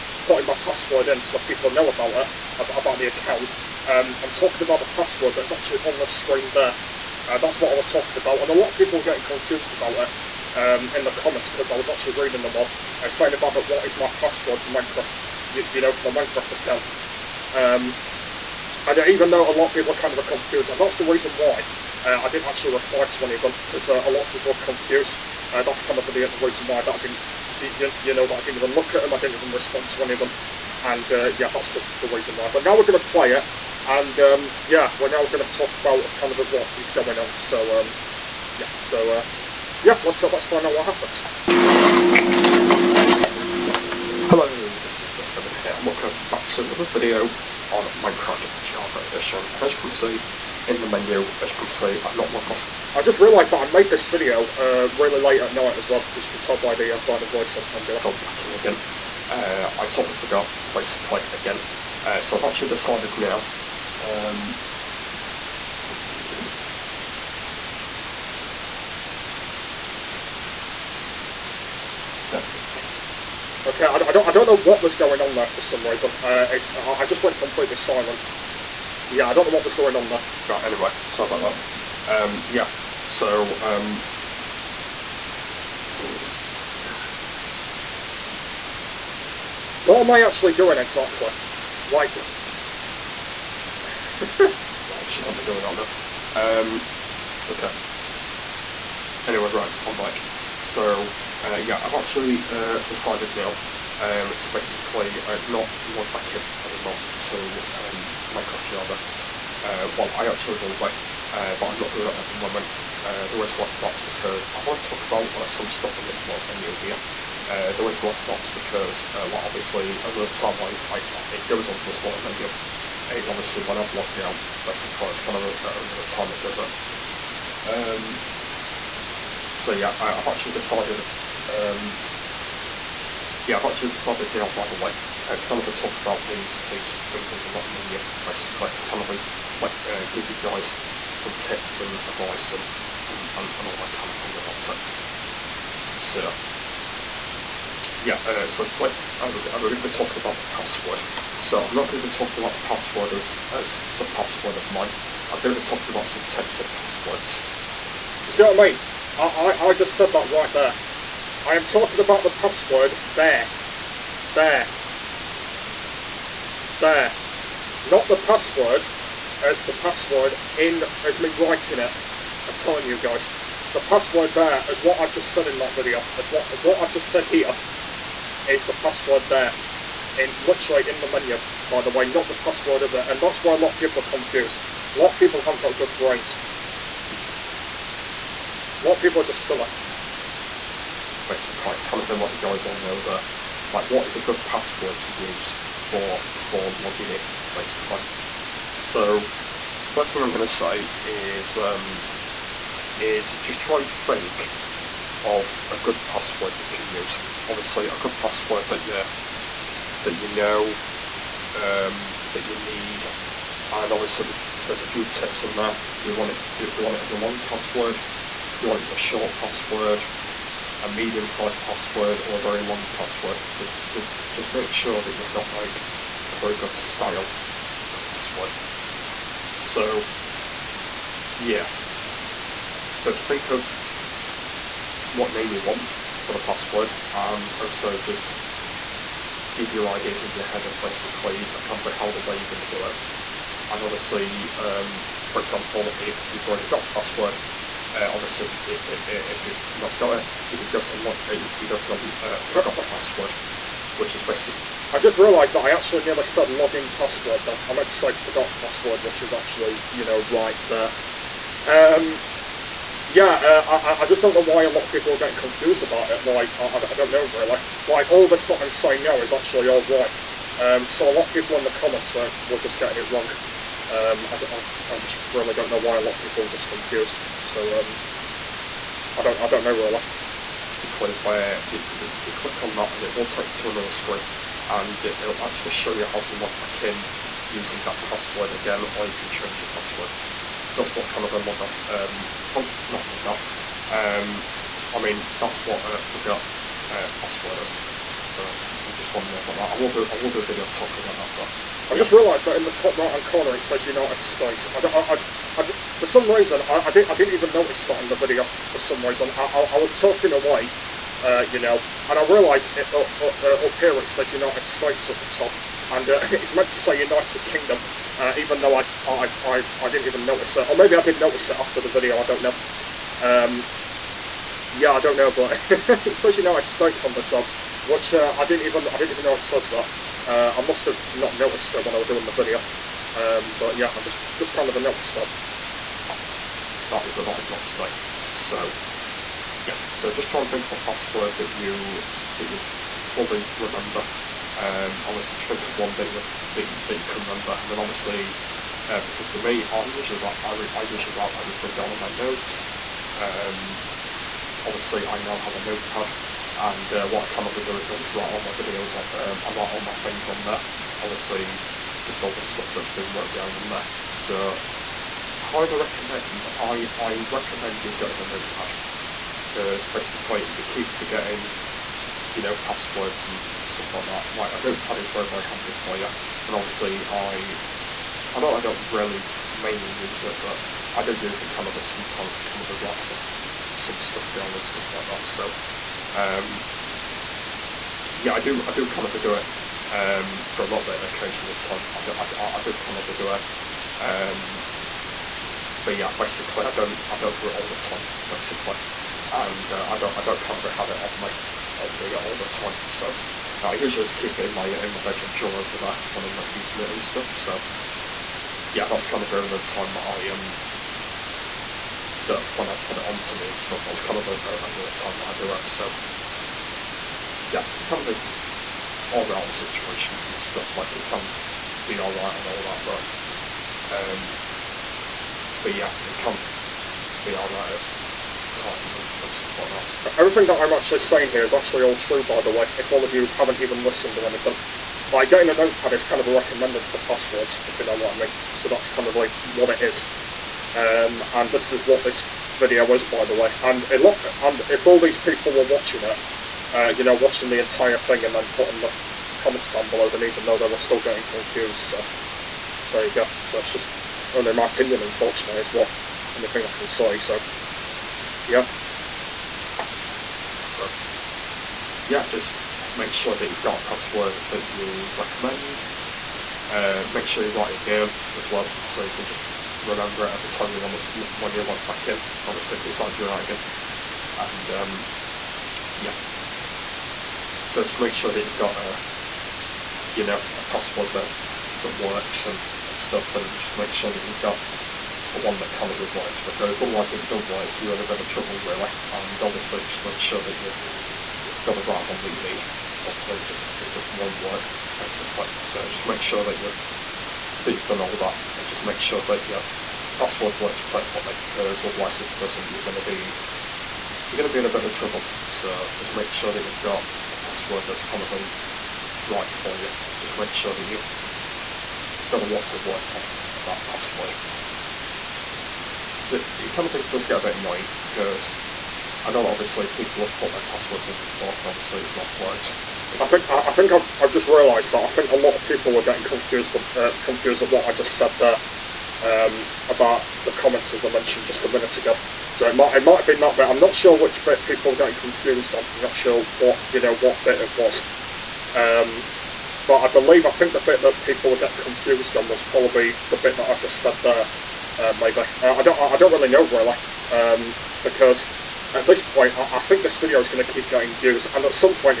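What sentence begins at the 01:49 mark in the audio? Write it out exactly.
Uh, well, I actually will be, uh, but I'm not doing it at the moment.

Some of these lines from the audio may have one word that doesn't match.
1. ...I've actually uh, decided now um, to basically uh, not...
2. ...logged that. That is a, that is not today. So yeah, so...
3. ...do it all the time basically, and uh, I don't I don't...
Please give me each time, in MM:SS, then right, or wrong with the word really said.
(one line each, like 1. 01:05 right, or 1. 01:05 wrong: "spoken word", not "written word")
1. 01:41 right
2. 05:34 wrong: "noticed", not "logged"
3. 06:37 right.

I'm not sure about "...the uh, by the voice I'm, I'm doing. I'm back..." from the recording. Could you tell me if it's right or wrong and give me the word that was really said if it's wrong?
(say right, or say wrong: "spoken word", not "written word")
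right.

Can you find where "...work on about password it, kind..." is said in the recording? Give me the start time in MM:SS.
08:32.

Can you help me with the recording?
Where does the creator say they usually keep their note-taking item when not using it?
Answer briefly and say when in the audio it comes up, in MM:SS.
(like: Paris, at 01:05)
bedroom drawer, at 06:45.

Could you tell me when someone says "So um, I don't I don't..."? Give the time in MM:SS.
04:37.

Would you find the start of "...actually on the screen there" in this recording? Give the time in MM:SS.
00:05.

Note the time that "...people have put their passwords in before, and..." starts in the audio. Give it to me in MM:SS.
08:39.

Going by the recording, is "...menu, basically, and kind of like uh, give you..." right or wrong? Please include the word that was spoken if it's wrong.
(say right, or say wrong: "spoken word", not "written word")
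right.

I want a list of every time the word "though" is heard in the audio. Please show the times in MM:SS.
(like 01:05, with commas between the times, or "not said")
00:19, 05:18, 07:30.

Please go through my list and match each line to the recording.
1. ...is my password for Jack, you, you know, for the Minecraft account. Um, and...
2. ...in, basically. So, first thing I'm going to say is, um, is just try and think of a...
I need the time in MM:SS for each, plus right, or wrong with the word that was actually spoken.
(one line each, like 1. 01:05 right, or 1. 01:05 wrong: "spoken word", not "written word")
1. 00:13 wrong: "Minecraft", not "Jack"
2. 03:17 right.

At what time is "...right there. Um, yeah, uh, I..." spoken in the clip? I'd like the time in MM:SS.
04:20.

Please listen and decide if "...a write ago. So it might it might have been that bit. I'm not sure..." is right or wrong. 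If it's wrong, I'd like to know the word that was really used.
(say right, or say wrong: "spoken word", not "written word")
wrong: "minute", not "write".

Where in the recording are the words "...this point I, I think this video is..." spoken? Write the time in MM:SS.
09:09.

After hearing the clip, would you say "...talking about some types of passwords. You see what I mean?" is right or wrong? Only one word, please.
right.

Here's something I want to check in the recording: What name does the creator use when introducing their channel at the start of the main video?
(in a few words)
Jack's Gaming.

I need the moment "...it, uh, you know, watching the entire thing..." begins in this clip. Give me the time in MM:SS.
07:26.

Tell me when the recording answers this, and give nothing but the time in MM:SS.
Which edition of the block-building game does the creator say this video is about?
00:48.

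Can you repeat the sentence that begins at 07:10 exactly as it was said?
Everything that I'm actually saying here is actually all true, by the way, if all of you haven't even listened or anything.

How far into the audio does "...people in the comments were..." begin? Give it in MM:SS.
04:31.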